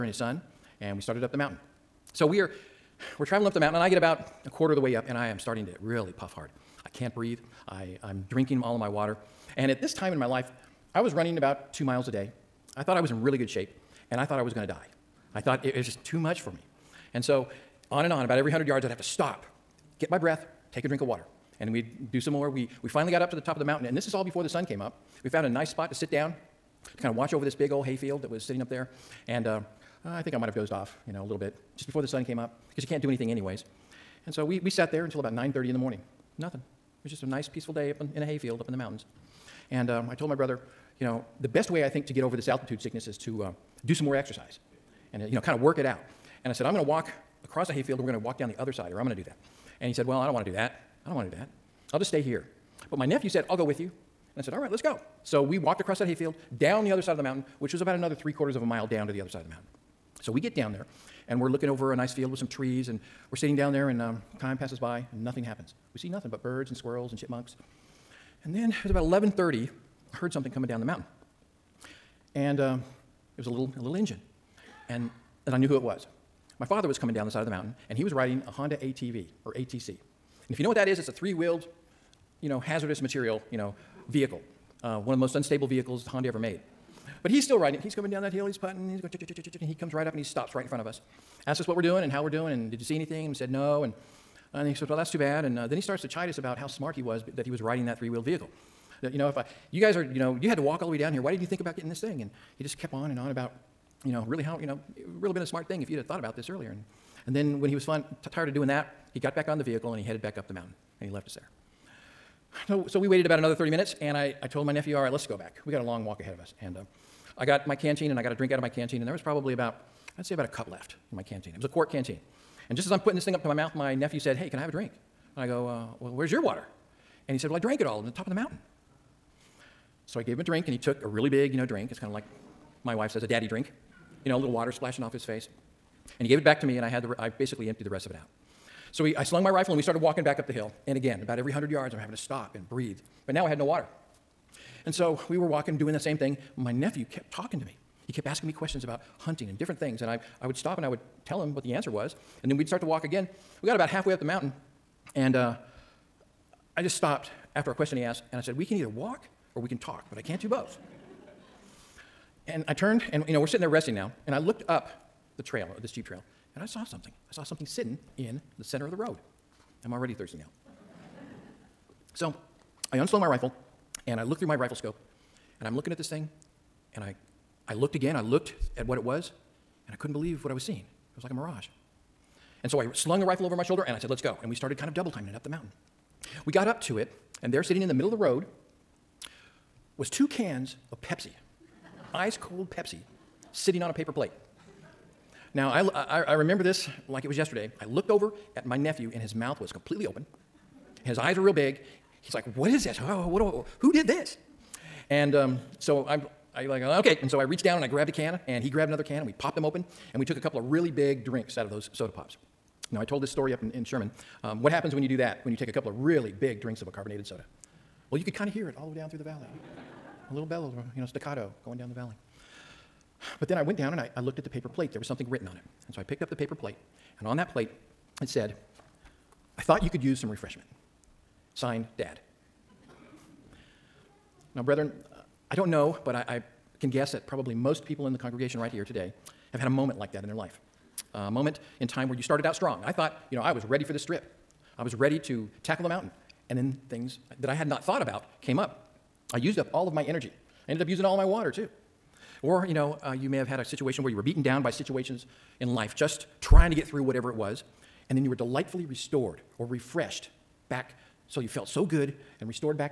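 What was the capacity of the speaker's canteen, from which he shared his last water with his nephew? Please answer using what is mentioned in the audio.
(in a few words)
a quart.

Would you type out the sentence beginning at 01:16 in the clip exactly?
My father was coming down the side of the mountain, and he was riding a Honda ATV or ATC.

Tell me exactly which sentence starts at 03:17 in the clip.
I looked over at my nephew, and his mouth was completely open and his eyes were real big.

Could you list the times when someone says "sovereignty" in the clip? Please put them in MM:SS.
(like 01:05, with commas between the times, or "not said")
not said.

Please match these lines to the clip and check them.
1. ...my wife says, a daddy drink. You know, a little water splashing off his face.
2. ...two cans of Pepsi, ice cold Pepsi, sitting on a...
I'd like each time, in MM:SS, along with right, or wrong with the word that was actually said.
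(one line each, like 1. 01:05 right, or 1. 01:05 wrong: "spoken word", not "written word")
1. 02:12 right
2. 03:10 right.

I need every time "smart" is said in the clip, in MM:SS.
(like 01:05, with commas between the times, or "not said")
01:36, 01:45.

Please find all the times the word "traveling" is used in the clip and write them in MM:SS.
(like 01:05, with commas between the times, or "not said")
00:03.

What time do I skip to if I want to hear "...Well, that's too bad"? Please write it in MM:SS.
01:34.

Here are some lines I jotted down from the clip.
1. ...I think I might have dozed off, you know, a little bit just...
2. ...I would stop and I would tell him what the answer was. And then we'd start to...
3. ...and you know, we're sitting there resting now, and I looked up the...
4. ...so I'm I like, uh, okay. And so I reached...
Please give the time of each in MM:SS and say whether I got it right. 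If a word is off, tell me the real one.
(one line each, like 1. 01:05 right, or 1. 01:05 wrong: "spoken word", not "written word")
1. 00:30 right
2. 02:30 right
3. 02:43 right
4. 03:25 right.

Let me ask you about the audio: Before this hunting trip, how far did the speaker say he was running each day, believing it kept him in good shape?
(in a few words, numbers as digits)
2 miles.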